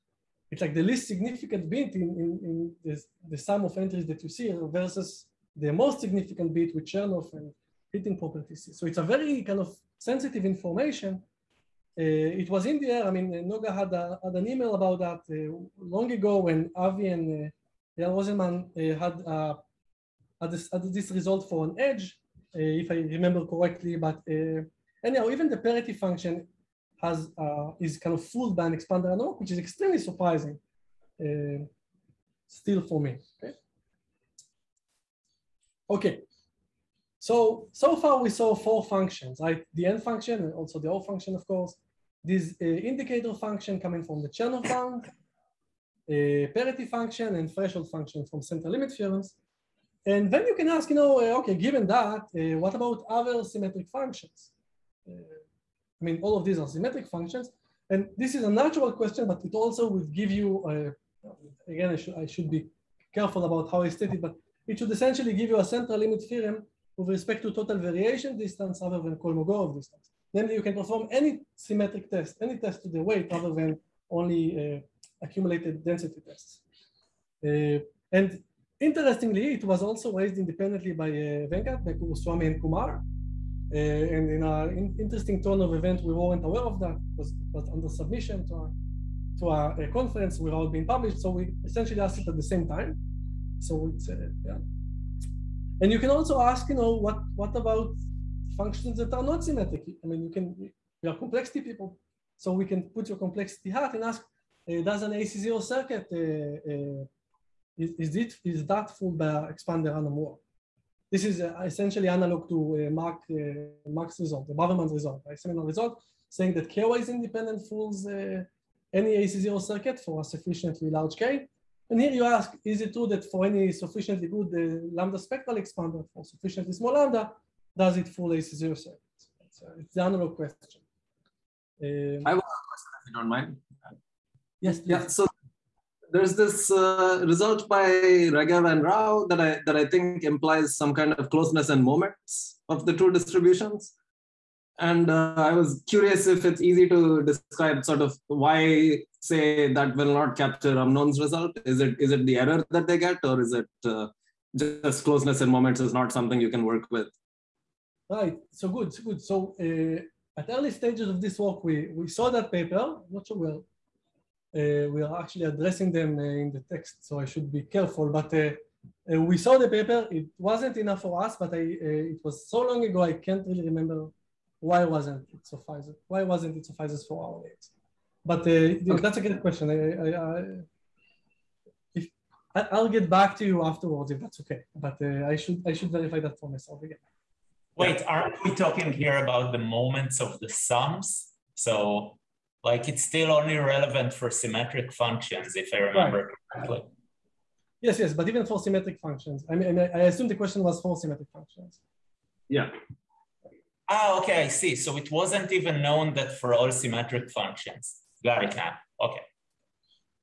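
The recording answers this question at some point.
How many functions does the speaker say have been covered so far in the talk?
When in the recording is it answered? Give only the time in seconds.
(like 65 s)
38 s.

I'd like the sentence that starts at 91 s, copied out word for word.
So we essentially asked it at the same time.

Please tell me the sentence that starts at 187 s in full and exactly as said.
Wait, aren't we talking here about the moments of the sums?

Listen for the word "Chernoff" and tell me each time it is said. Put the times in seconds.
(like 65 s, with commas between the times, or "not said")
6 s, 44 s.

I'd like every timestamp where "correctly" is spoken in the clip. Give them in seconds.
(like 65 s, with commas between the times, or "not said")
23 s, 196 s.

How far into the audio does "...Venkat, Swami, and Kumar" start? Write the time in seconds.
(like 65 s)
81 s.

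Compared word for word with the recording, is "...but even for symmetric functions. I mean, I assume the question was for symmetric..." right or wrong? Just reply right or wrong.
right.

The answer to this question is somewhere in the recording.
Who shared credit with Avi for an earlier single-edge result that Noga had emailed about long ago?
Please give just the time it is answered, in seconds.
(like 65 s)
18 s.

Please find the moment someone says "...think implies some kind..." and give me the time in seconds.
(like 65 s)
139 s.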